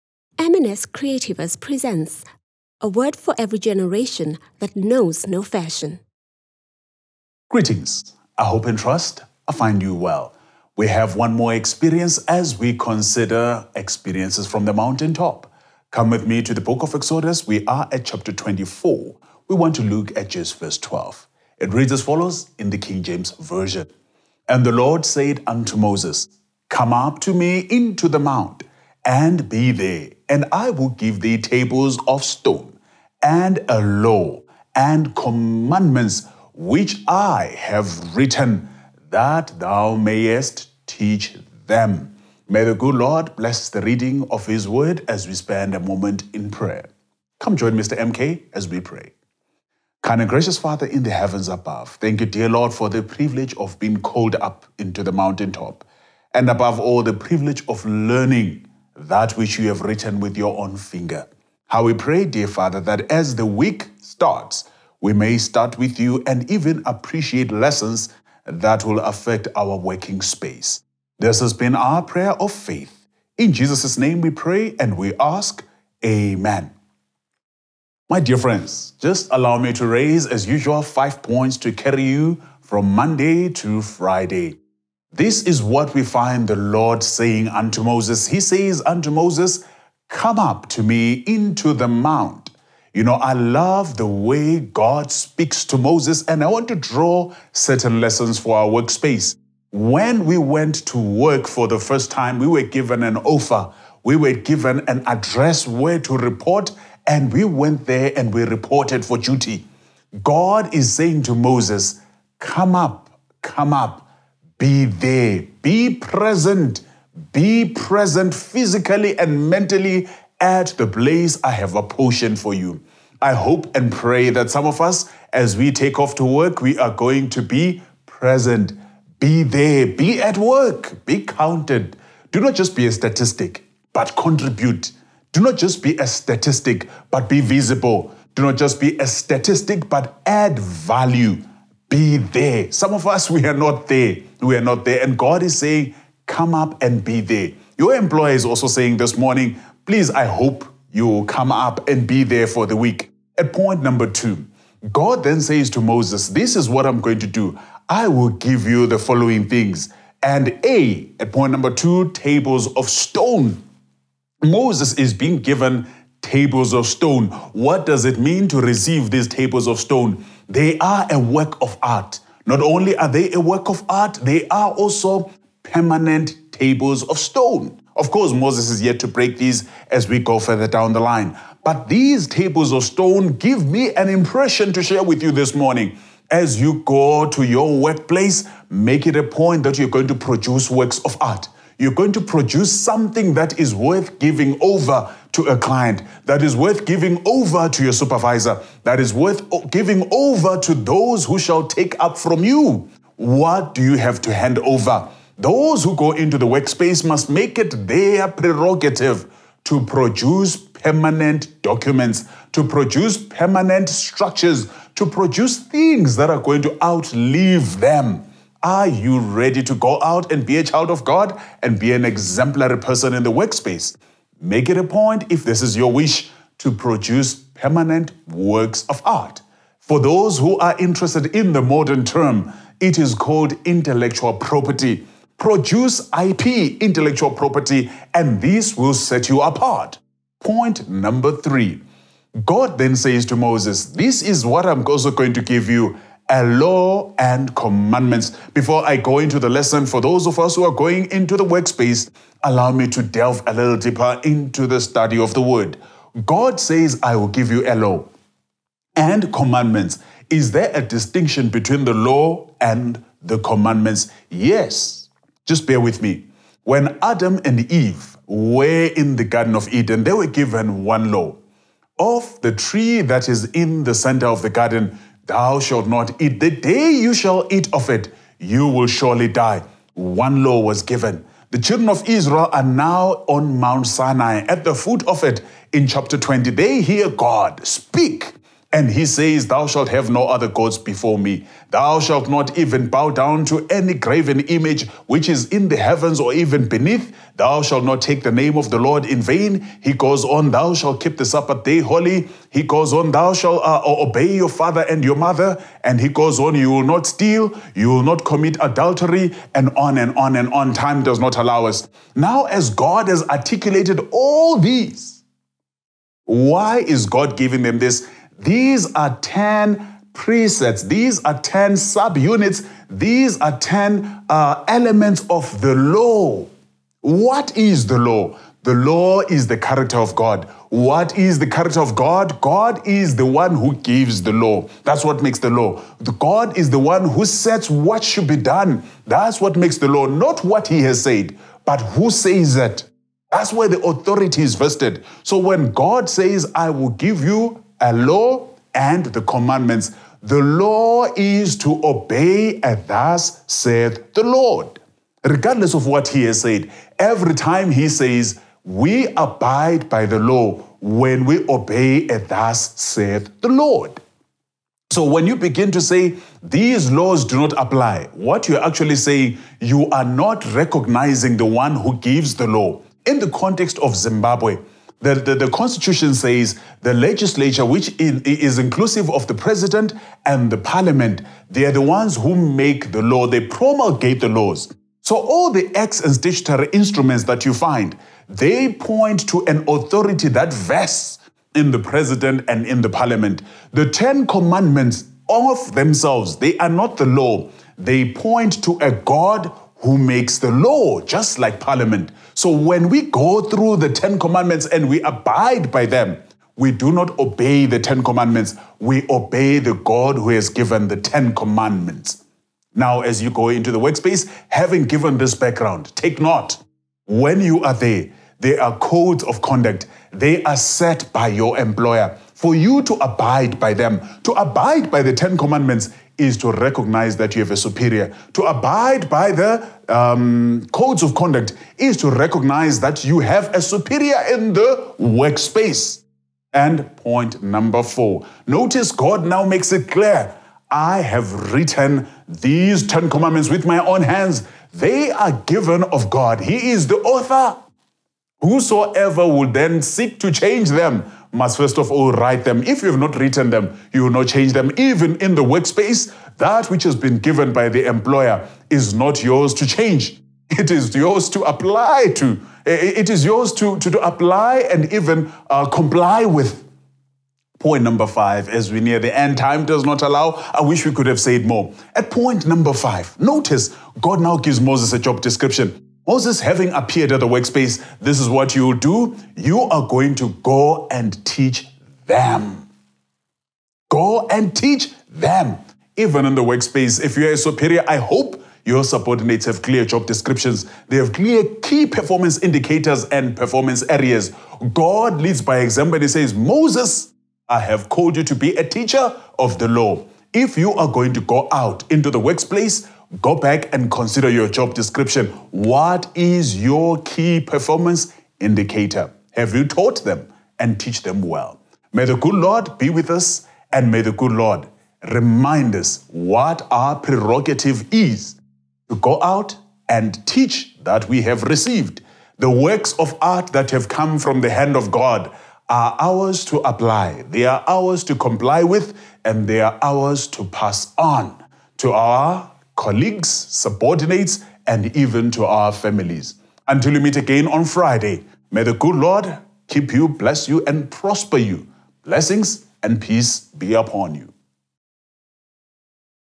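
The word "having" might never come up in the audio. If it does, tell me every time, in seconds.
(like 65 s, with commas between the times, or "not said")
414 s, 476 s.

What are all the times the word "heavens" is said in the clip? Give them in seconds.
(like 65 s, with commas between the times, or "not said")
51 s, 295 s.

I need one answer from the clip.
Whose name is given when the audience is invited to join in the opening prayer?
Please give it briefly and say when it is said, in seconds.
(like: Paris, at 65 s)
Mr. MK, at 47 s.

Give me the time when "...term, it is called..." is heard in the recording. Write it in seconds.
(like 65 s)
232 s.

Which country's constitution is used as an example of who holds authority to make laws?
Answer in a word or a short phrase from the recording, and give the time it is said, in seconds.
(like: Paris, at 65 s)
Zimbabwe, at 373 s.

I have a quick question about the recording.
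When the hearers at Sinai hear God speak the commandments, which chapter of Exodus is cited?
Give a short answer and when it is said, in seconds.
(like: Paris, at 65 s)
chapter 20, at 285 s.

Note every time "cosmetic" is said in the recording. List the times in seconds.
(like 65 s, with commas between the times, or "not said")
not said.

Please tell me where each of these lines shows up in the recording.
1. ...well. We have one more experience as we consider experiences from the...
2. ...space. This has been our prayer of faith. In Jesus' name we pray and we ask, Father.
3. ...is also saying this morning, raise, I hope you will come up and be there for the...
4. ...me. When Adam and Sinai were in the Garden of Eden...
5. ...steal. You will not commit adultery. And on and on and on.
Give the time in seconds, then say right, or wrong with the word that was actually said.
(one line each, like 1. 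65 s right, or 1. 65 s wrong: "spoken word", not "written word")
1. 9 s right
2. 70 s wrong: "Amen", not "Father"
3. 148 s wrong: "please", not "raise"
4. 266 s wrong: "Eve", not "Sinai"
5. 307 s right.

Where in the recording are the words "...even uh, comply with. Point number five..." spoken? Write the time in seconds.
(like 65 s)
464 s.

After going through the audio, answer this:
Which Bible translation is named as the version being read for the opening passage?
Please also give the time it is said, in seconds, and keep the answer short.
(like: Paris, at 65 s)
King James Version, at 22 s.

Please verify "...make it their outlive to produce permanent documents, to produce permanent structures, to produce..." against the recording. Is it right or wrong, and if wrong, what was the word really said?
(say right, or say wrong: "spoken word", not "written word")
wrong: "prerogative", not "outlive".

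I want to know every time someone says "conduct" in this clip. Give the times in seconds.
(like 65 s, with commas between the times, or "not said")
419 s, 431 s.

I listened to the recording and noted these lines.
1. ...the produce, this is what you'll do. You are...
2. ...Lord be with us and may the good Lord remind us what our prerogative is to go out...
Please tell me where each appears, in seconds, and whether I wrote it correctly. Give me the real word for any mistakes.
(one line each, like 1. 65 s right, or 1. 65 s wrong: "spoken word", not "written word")
1. 477 s wrong: "workspace", not "produce"
2. 512 s right.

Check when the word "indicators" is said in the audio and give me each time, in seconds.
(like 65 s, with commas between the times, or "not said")
492 s, 508 s.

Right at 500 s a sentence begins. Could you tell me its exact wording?
If you are going to go out into the workplace, go back and consider your job description.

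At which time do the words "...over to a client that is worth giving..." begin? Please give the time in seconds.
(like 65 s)
194 s.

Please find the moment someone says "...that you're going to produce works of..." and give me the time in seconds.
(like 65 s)
189 s.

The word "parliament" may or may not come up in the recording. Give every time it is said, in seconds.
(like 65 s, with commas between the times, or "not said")
380 s, 392 s, 401 s.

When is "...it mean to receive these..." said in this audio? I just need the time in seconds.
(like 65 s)
168 s.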